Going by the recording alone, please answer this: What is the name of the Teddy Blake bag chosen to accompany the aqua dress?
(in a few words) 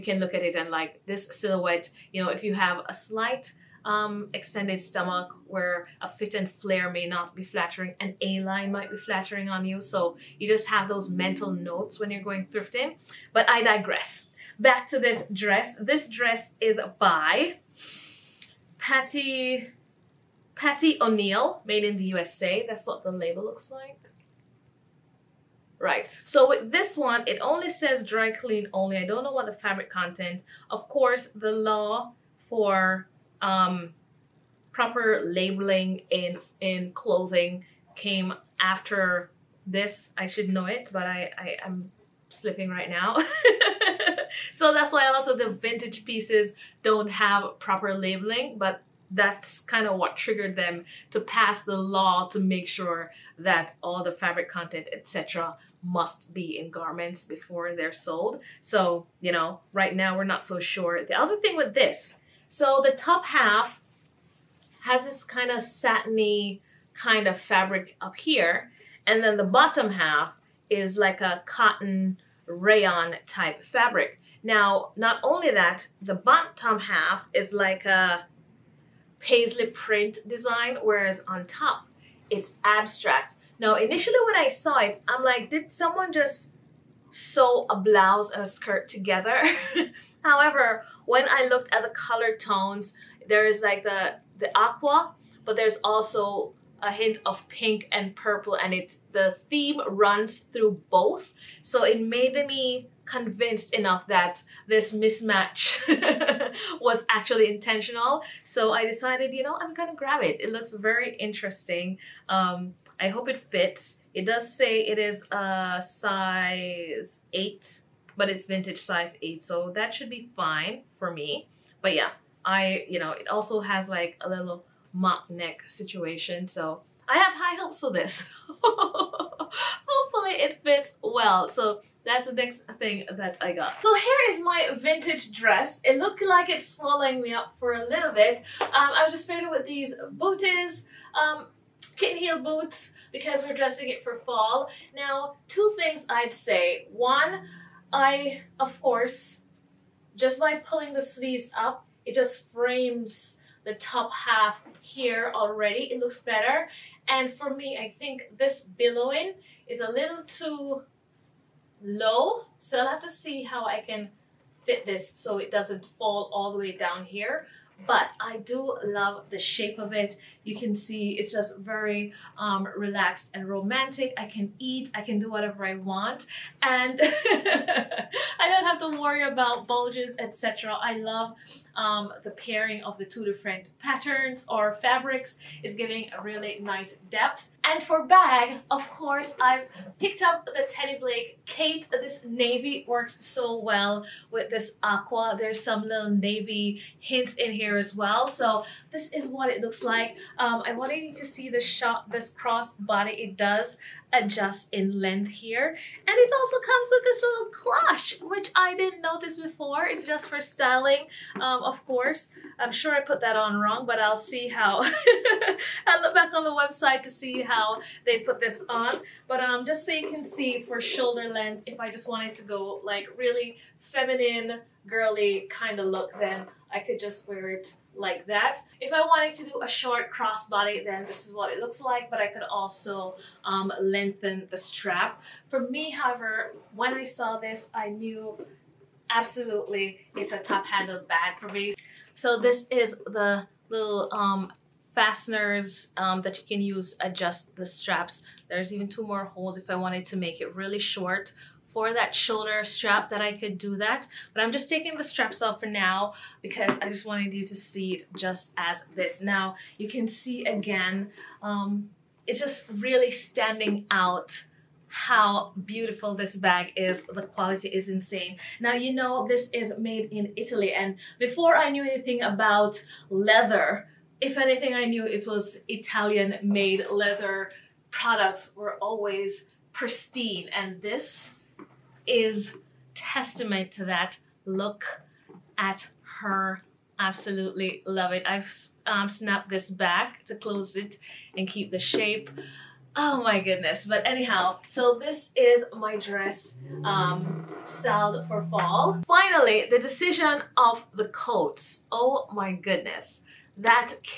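Kate.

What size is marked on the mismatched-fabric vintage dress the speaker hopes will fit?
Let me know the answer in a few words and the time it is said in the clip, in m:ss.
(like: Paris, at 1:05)
8, at 1:55.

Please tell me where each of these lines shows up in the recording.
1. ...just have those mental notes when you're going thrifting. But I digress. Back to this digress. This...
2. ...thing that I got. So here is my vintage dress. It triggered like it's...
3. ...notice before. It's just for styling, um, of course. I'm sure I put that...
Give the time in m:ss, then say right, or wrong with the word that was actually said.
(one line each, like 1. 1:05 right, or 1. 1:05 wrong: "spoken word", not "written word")
1. 0:10 wrong: "dress", not "digress"
2. 2:12 wrong: "looked", not "triggered"
3. 3:29 right.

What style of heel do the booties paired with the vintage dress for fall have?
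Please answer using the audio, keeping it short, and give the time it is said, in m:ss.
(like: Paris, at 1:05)
Kitten heel, at 2:21.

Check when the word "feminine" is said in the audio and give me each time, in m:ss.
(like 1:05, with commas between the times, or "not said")
3:43.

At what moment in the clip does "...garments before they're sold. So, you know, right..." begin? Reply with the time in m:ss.
0:56.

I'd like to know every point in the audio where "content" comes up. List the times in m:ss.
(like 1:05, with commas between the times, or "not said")
0:29, 0:54.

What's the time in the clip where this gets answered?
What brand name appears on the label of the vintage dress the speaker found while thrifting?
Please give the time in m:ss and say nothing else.
0:20.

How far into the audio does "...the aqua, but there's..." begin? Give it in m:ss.
1:34.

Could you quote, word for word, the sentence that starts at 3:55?
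For me, however, when I saw this, I knew absolutely it's a top handle bag for me.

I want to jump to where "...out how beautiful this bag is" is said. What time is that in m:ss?
4:23.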